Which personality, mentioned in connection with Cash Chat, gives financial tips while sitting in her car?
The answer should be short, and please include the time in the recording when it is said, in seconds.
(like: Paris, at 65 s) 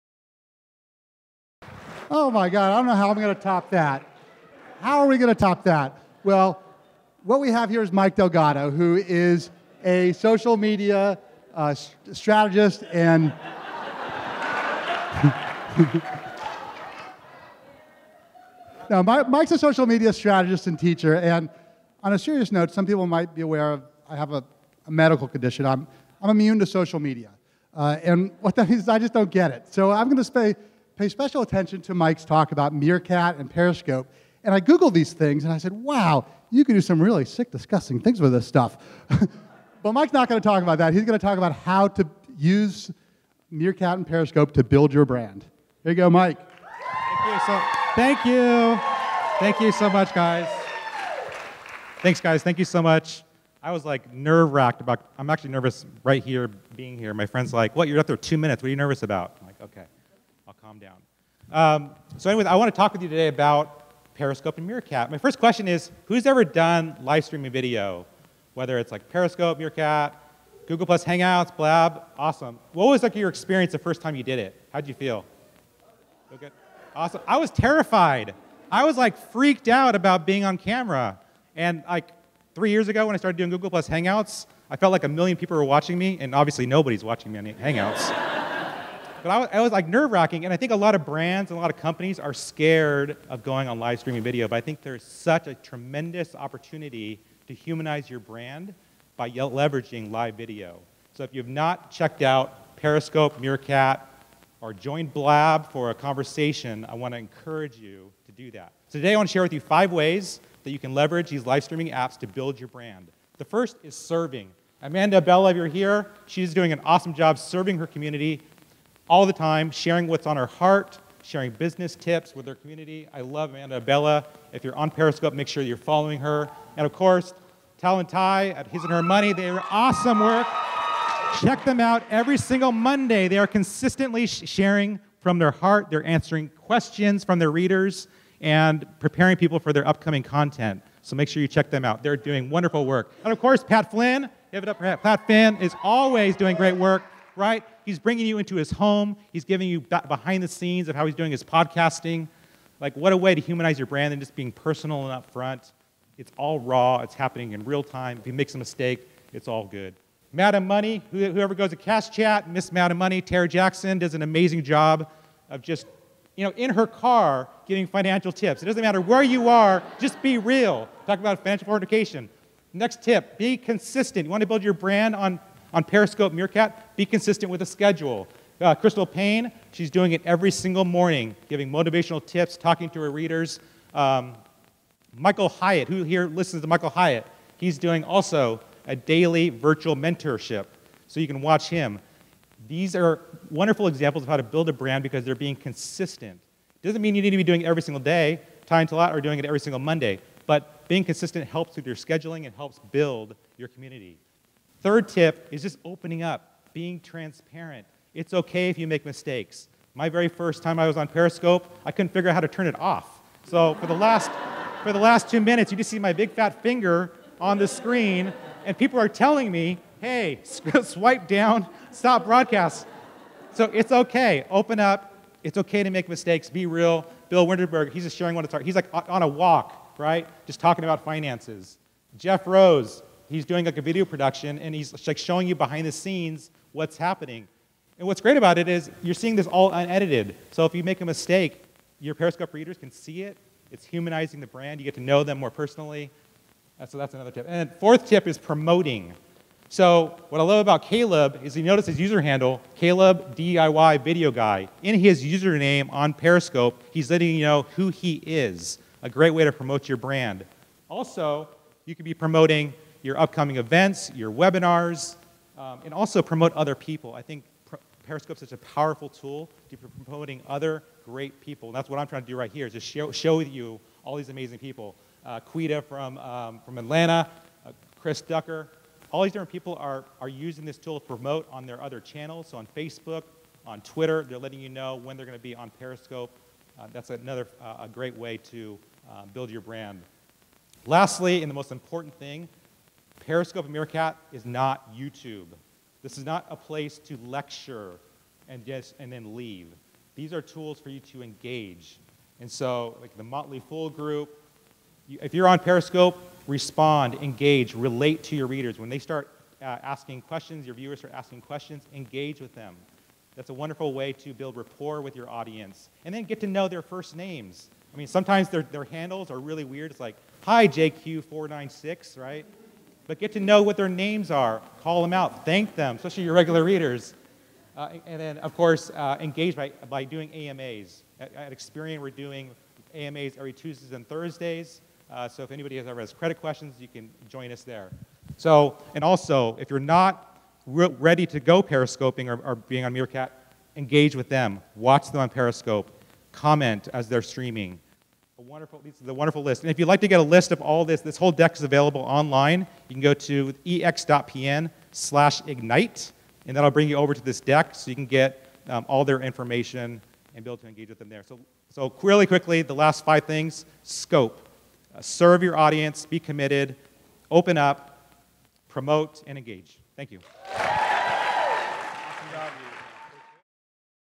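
Tara Jackson, at 163 s.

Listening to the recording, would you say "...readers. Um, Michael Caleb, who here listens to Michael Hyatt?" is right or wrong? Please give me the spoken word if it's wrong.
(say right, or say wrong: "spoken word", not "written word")
wrong: "Hyatt", not "Caleb".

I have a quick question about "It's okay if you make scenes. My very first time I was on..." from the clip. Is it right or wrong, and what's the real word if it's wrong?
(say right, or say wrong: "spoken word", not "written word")
wrong: "mistakes", not "scenes".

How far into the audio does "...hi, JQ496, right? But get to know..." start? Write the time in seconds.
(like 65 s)
320 s.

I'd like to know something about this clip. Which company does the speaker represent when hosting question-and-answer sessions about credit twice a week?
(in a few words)
Experian.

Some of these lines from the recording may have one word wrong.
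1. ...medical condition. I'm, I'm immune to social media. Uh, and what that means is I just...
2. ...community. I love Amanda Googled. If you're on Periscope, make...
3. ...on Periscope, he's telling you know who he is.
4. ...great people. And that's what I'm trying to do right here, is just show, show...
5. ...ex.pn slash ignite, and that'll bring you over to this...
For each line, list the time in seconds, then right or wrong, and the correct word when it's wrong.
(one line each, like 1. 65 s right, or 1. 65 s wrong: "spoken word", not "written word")
1. 24 s right
2. 122 s wrong: "Abella", not "Googled"
3. 255 s wrong: "letting", not "telling"
4. 271 s right
5. 353 s right.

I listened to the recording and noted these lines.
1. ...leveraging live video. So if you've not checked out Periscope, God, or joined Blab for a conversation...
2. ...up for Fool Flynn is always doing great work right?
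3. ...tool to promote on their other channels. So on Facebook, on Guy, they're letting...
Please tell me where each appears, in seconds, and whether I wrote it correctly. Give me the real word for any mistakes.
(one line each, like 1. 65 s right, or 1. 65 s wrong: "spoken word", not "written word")
1. 99 s wrong: "Meerkat", not "God"
2. 144 s wrong: "Pat", not "Fool"
3. 280 s wrong: "Twitter", not "Guy".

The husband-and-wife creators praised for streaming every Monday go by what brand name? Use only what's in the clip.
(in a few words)
His and Her Money.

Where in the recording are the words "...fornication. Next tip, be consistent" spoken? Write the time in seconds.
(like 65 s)
171 s.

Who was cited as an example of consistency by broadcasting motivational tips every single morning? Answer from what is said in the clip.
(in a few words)
Crystal Paine.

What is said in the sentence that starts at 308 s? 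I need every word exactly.
When they start uh, asking questions, your viewers start asking questions, engage with them.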